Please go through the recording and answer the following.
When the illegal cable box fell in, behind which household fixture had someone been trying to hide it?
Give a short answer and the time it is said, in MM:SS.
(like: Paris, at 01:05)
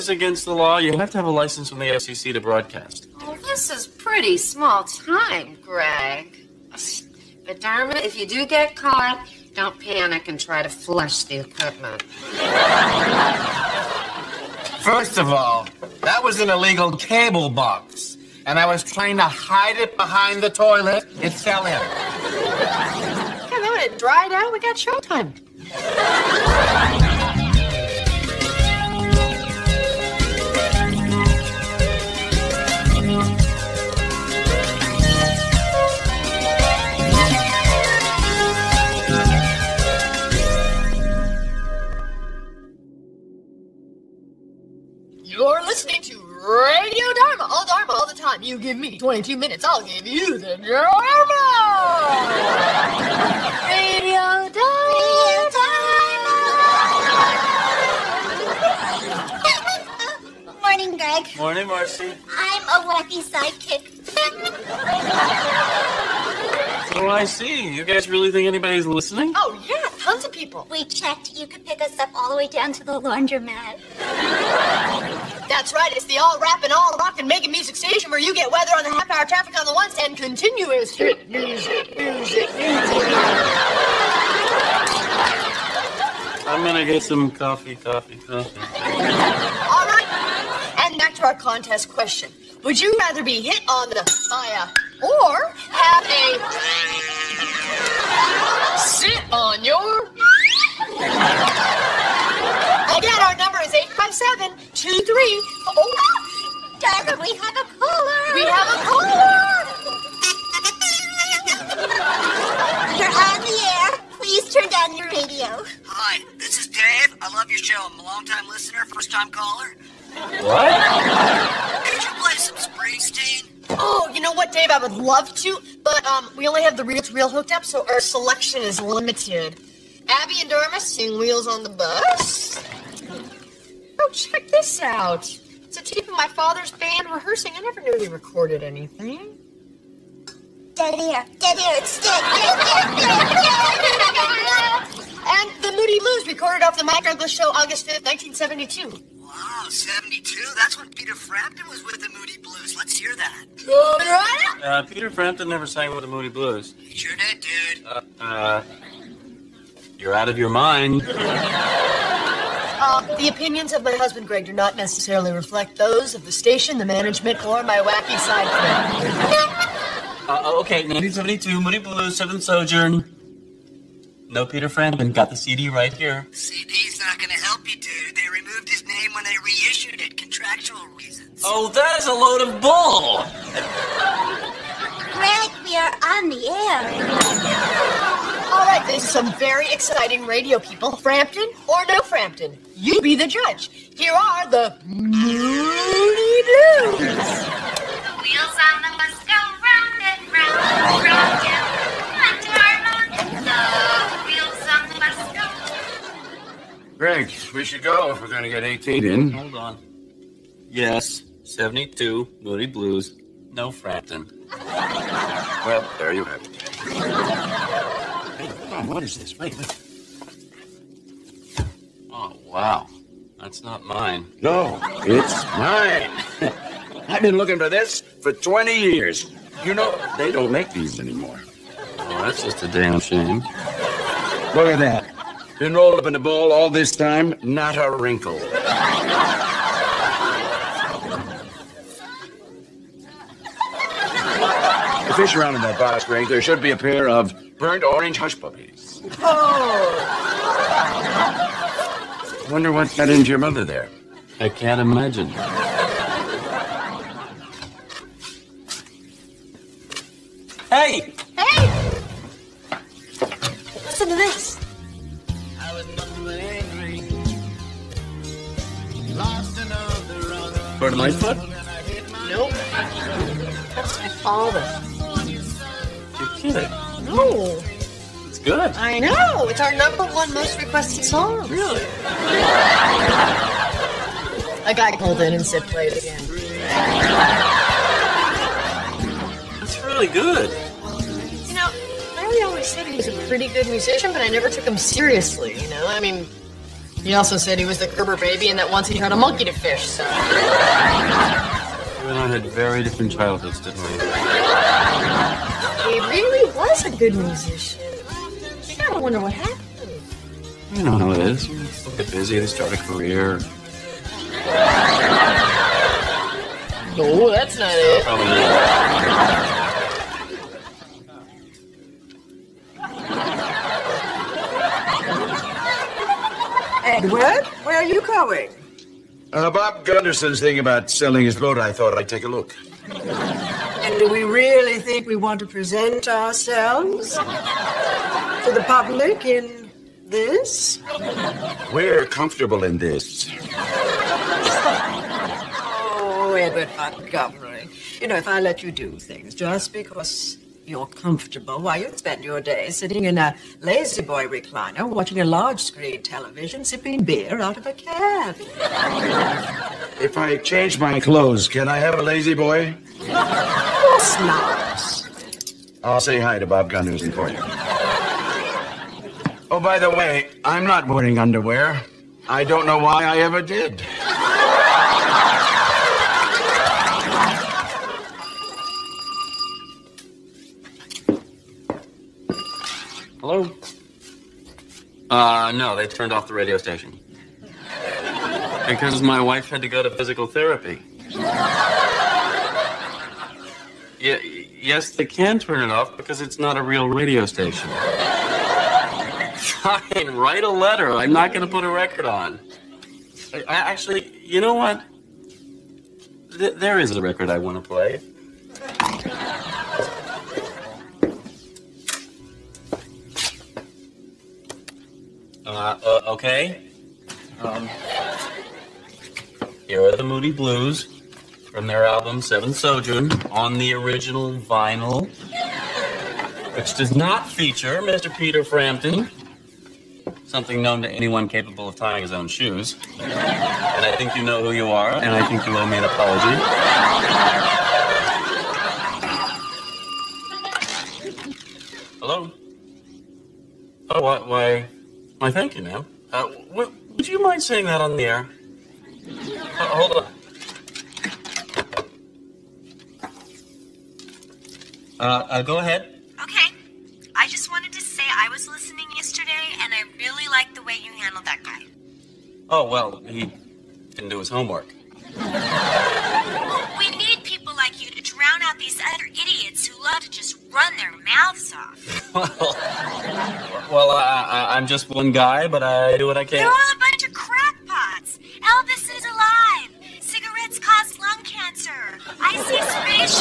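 the toilet, at 00:20.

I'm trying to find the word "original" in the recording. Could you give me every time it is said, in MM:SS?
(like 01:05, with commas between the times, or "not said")
07:03.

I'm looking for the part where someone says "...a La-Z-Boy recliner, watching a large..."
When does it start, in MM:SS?
05:53.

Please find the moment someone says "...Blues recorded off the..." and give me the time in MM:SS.
02:26.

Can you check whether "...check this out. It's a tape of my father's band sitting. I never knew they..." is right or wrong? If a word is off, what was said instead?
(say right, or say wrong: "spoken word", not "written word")
wrong: "rehearsing", not "sitting".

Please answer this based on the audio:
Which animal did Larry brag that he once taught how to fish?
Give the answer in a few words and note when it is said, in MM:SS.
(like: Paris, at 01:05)
a monkey, at 04:59.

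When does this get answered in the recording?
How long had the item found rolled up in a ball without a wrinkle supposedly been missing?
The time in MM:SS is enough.
03:48.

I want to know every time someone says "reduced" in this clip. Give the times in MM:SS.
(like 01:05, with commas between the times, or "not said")
not said.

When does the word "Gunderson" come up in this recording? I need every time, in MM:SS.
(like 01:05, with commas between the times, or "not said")
05:29, 06:06.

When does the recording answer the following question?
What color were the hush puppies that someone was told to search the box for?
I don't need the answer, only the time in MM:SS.
04:07.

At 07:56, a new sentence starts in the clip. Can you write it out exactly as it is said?
You're all a bunch of crackpots.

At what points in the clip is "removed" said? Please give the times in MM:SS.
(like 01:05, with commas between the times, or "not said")
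02:58.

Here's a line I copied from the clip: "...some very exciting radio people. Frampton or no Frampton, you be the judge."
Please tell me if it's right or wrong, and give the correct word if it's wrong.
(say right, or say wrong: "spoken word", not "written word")
right.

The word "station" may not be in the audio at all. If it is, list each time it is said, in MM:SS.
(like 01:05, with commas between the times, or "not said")
01:17, 02:46, 06:26, 06:37.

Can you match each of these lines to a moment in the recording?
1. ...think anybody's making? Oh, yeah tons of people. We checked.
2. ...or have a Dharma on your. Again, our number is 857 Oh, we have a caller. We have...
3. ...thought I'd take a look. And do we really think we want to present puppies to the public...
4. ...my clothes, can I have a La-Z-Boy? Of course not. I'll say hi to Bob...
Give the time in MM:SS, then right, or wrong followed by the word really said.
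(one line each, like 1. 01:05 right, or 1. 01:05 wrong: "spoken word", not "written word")
1. 01:08 wrong: "listening", not "making"
2. 01:35 wrong: "Sit", not "Dharma"
3. 05:31 wrong: "ourselves", not "puppies"
4. 06:00 right.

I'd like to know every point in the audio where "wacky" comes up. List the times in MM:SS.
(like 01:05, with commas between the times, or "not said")
01:02, 02:47.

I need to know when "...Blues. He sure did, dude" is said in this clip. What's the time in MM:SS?
02:36.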